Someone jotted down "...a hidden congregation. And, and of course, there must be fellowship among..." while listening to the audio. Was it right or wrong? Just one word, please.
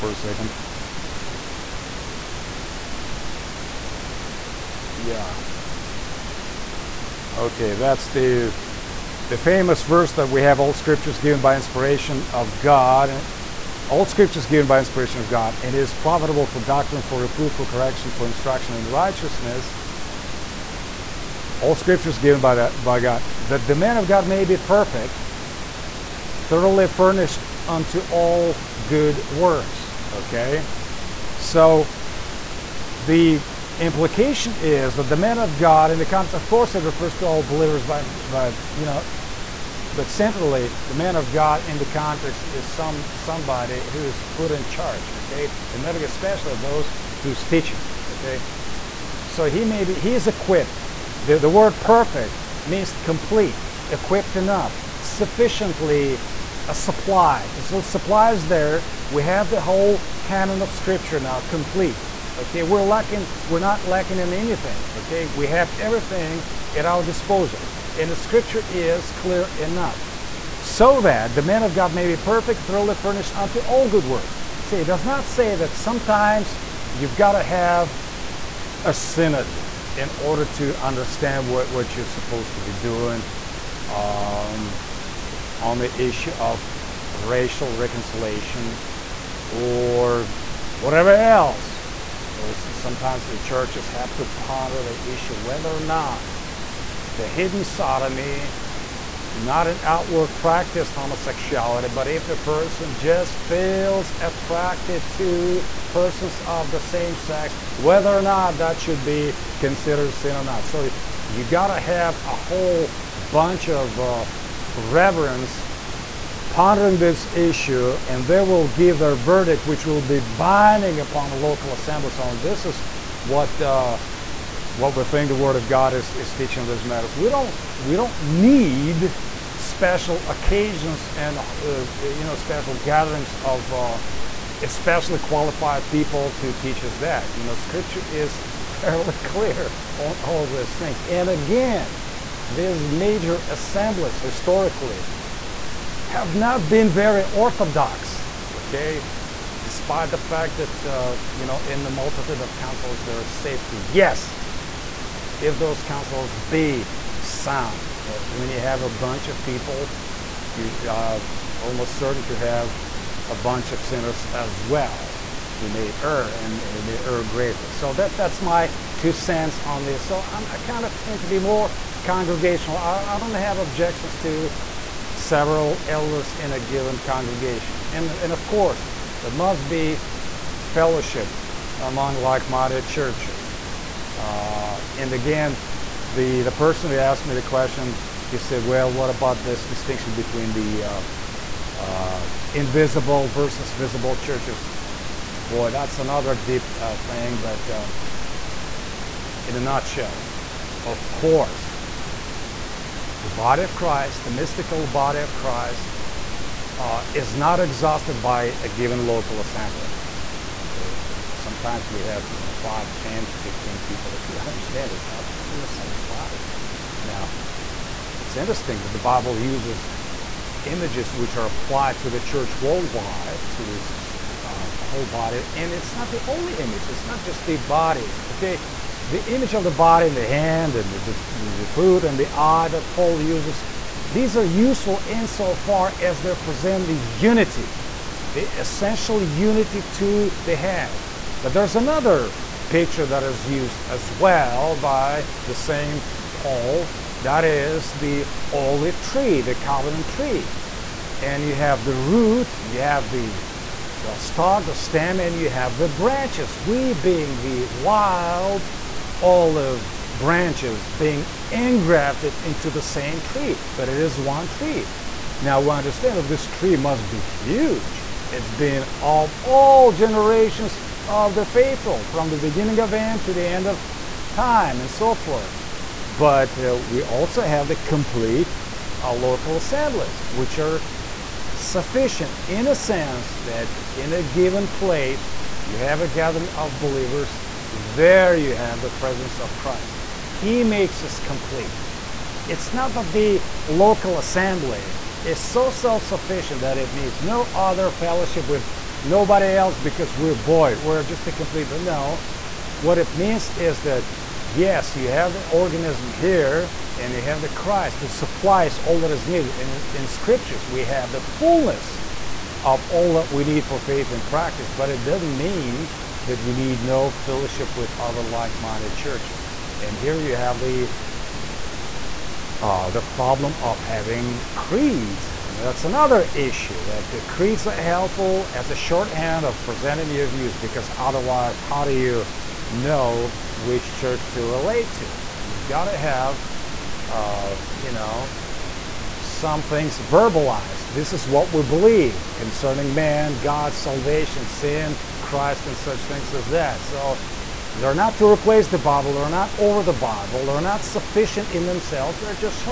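wrong.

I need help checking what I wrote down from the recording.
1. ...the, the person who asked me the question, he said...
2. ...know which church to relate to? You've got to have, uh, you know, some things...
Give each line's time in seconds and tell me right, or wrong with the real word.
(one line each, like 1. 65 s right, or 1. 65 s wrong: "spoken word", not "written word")
1. 186 s right
2. 332 s right.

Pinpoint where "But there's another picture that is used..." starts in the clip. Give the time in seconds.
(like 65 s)
241 s.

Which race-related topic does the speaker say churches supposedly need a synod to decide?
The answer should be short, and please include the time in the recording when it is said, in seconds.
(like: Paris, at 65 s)
racial reconciliation, at 87 s.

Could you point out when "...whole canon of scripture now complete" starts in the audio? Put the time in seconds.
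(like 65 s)
59 s.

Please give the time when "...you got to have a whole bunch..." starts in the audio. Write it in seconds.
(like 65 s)
111 s.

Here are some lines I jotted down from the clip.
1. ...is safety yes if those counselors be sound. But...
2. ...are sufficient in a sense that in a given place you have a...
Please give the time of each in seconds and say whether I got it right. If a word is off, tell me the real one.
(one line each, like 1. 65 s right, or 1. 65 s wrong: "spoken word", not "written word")
1. 153 s right
2. 280 s right.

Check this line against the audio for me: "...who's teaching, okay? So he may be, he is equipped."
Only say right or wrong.
right.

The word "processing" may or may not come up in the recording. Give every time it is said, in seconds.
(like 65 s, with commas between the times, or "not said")
not said.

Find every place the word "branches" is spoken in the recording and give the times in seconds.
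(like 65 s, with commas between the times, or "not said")
255 s, 260 s.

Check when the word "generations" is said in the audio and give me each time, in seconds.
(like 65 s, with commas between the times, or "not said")
269 s.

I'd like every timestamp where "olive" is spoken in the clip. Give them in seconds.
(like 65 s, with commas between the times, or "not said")
248 s, 259 s.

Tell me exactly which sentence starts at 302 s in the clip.
What it means is that yes, you have the organism here and you have the Christ who supplies all that is needed.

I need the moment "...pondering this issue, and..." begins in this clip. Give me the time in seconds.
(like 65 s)
116 s.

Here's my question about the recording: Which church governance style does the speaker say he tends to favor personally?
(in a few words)
congregational.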